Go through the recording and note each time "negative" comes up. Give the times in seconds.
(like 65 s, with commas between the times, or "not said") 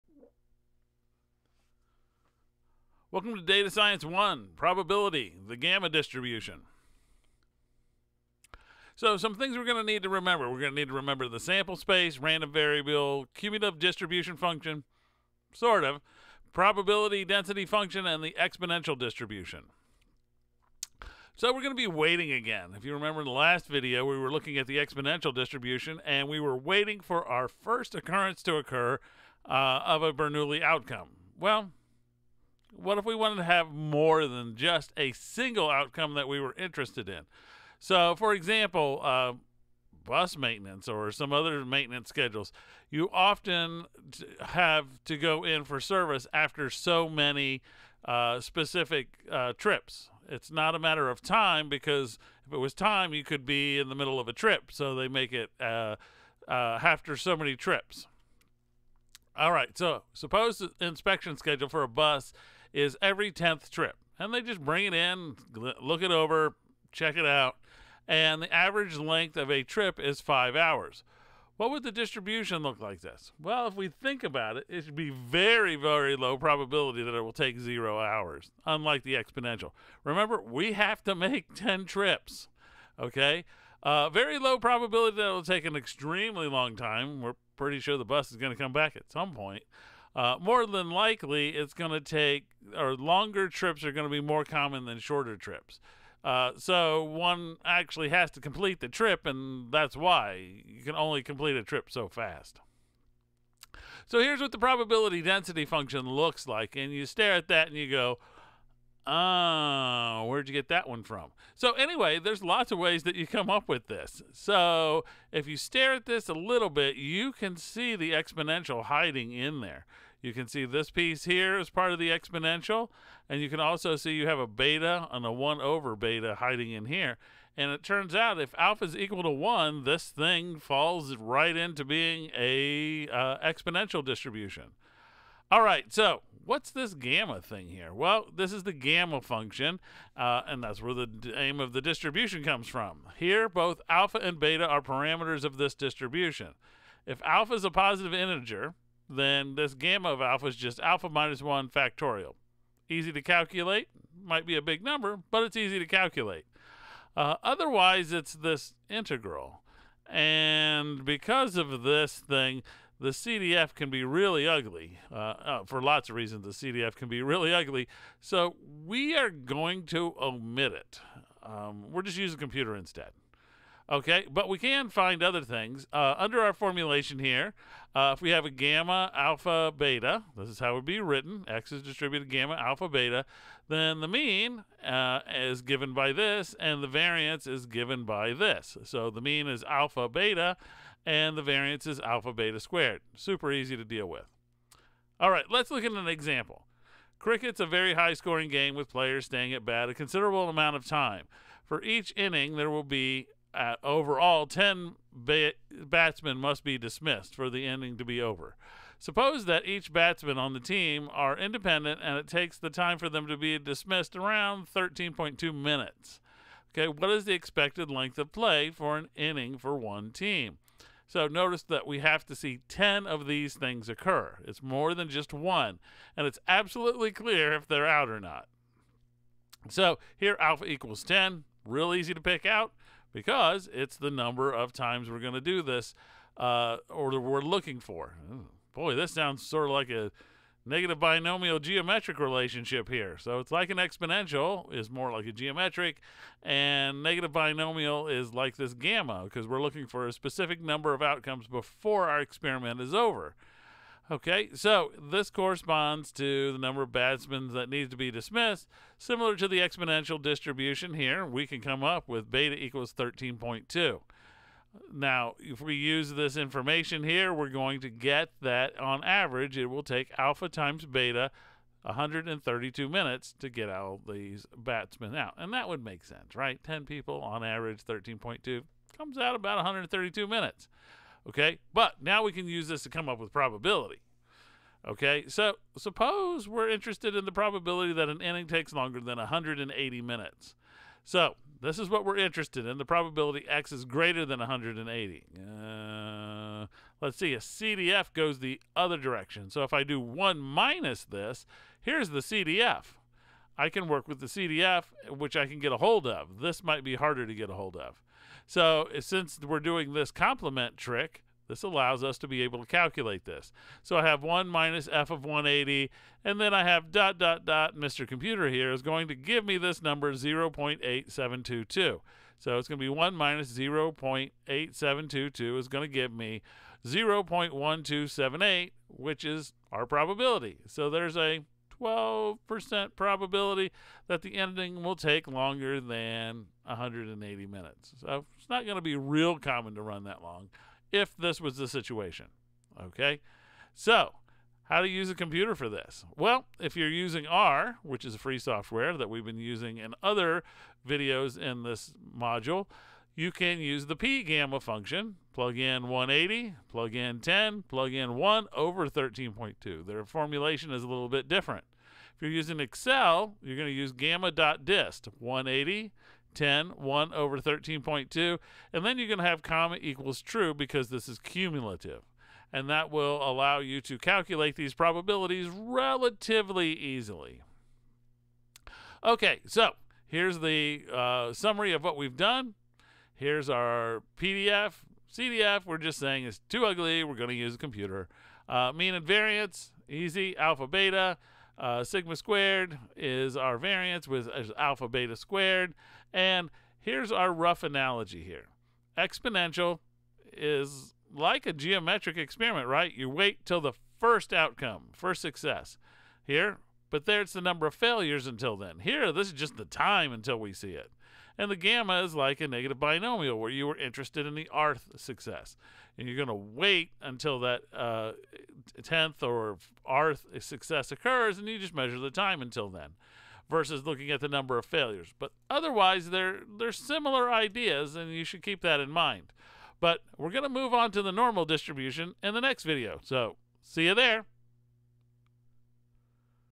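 240 s, 247 s, 412 s.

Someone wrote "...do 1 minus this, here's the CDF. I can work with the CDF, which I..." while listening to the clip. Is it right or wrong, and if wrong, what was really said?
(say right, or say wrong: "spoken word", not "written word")
right.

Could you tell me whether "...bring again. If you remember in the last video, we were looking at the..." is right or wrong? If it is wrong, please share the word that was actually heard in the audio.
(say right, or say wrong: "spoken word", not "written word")
wrong: "waiting", not "bring".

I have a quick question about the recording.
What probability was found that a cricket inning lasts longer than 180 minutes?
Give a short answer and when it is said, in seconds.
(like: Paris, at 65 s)
0.1278, at 326 s.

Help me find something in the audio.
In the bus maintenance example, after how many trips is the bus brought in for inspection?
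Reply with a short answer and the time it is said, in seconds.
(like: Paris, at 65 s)
10th trip, at 63 s.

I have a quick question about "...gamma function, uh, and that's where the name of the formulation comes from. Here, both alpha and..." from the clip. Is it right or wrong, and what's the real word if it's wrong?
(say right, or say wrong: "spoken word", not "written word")
wrong: "distribution", not "formulation".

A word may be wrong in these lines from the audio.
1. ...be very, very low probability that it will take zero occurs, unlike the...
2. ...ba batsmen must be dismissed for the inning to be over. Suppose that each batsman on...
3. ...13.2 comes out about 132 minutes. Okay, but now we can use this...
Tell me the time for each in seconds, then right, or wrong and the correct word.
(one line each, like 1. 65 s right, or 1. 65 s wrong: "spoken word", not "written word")
1. 74 s wrong: "hours", not "occurs"
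2. 205 s right
3. 277 s right.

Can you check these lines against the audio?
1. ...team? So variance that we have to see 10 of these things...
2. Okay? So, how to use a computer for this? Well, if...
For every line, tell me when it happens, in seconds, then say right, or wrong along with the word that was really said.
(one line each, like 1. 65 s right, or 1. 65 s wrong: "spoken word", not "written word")
1. 220 s wrong: "notice", not "variance"
2. 342 s right.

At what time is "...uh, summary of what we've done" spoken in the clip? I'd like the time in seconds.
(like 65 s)
380 s.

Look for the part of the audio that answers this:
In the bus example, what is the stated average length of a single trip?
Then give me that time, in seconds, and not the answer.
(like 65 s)
70 s.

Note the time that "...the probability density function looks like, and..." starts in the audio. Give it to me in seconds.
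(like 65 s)
104 s.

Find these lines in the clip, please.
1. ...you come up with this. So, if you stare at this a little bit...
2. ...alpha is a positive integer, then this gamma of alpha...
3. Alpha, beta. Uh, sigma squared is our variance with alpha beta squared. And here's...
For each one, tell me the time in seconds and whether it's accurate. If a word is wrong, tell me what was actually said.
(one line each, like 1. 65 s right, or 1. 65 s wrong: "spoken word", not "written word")
1. 113 s right
2. 147 s right
3. 390 s right.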